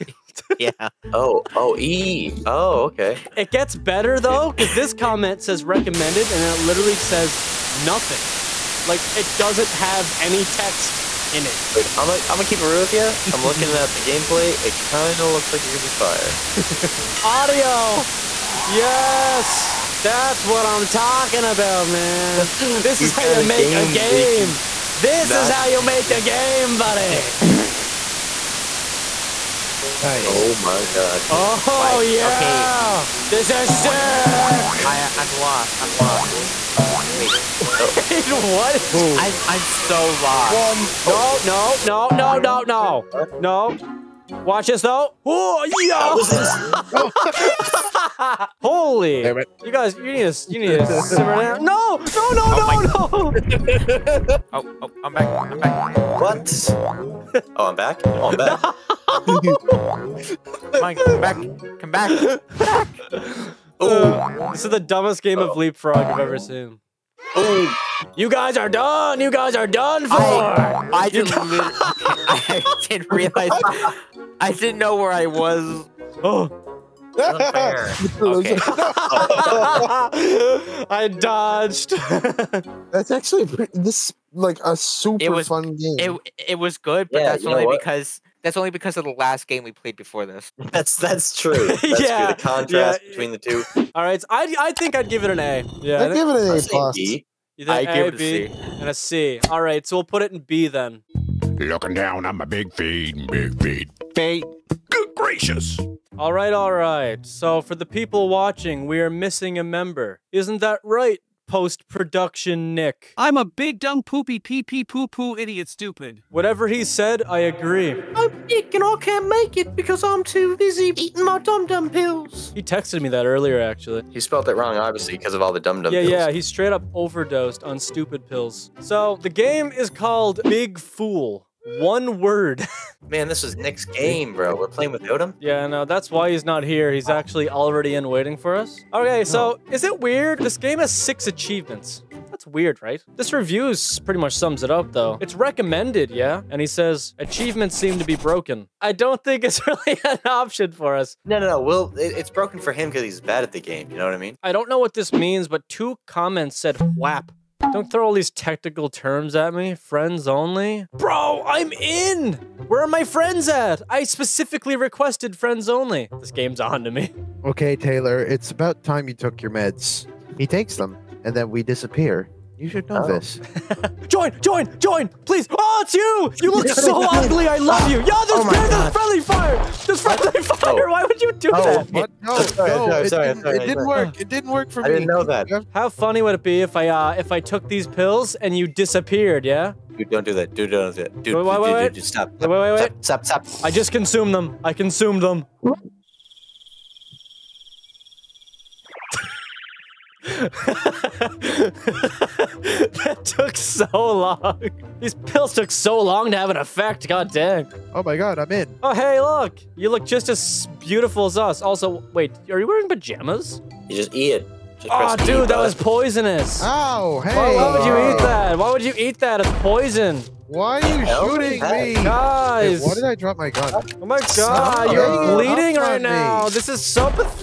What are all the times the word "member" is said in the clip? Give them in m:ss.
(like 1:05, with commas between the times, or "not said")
1:49.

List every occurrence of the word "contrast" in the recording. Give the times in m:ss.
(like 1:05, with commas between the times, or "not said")
1:32.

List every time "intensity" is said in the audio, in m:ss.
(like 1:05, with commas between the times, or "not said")
not said.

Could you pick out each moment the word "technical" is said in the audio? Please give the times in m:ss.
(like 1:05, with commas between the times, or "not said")
2:38.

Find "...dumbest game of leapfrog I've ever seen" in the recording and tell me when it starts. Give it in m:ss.
1:04.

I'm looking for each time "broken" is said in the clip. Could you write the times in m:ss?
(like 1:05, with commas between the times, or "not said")
2:28, 2:32.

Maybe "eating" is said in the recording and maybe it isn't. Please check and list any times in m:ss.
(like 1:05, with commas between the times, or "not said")
2:00.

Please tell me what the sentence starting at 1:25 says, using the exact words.
It it was good, but yeah, that's only because that's only because of the last game we played before this.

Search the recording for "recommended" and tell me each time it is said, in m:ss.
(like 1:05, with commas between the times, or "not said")
0:05, 2:25.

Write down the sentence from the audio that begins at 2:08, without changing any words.
So the game is called Big Fool.